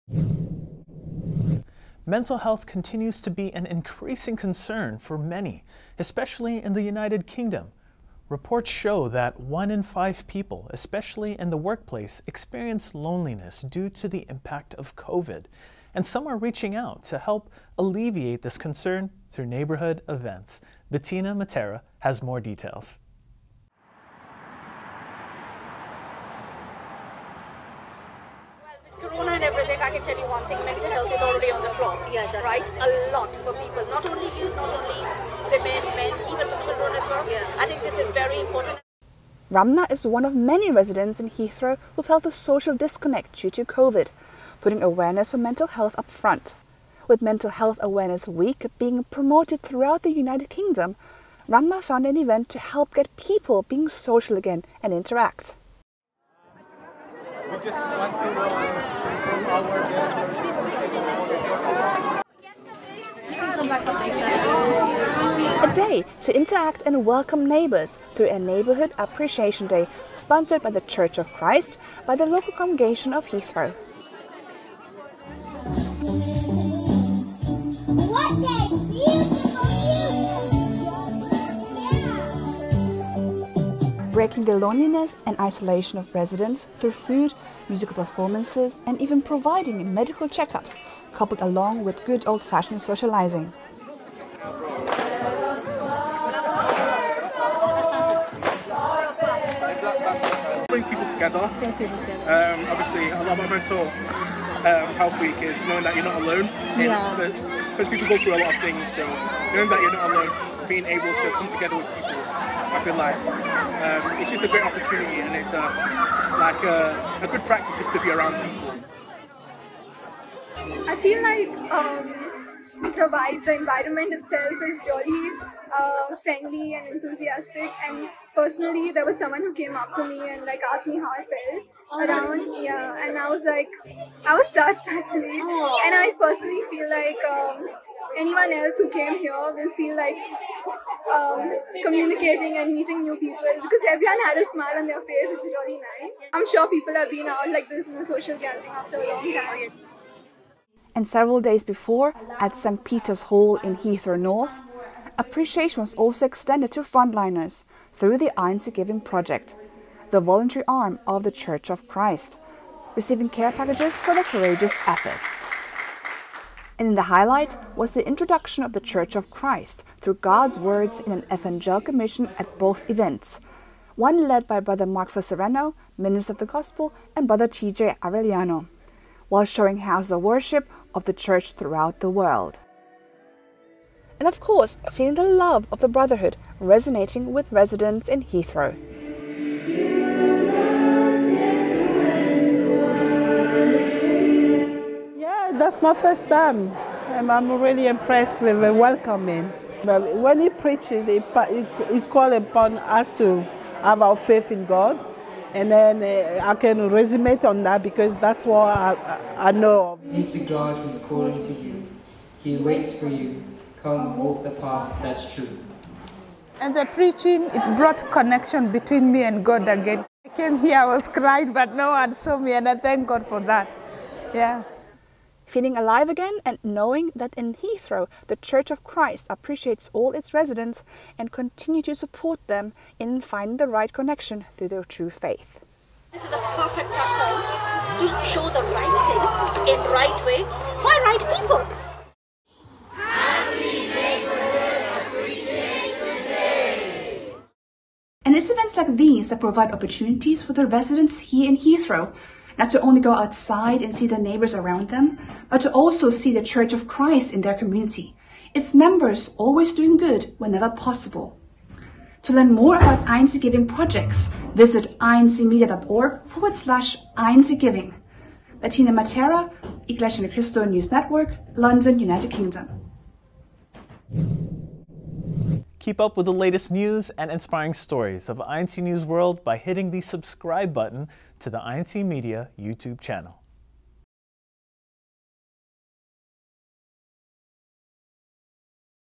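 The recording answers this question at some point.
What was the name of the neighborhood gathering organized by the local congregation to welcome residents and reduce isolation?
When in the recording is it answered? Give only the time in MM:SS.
01:08.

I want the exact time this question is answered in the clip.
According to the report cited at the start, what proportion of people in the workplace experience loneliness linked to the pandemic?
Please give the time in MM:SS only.
00:09.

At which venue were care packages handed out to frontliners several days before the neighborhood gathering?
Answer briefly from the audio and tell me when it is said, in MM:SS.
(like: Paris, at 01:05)
St. Peter's Hall, at 02:32.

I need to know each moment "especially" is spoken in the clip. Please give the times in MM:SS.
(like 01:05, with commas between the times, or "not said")
00:05, 00:10.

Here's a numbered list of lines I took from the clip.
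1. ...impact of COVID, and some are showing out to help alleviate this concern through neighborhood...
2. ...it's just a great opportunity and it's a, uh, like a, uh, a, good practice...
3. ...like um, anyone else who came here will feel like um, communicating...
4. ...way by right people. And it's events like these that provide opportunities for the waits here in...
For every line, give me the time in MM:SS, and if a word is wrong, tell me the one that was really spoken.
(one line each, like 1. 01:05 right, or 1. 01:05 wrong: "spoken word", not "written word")
1. 00:14 wrong: "reaching", not "showing"
2. 01:54 right
3. 02:16 right
4. 04:00 wrong: "residents", not "waits".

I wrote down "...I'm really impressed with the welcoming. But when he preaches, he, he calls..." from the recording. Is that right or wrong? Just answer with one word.
right.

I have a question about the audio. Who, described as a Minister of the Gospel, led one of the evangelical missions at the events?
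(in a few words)
Mark Sereno.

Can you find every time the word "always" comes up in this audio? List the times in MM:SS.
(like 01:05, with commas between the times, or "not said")
04:19.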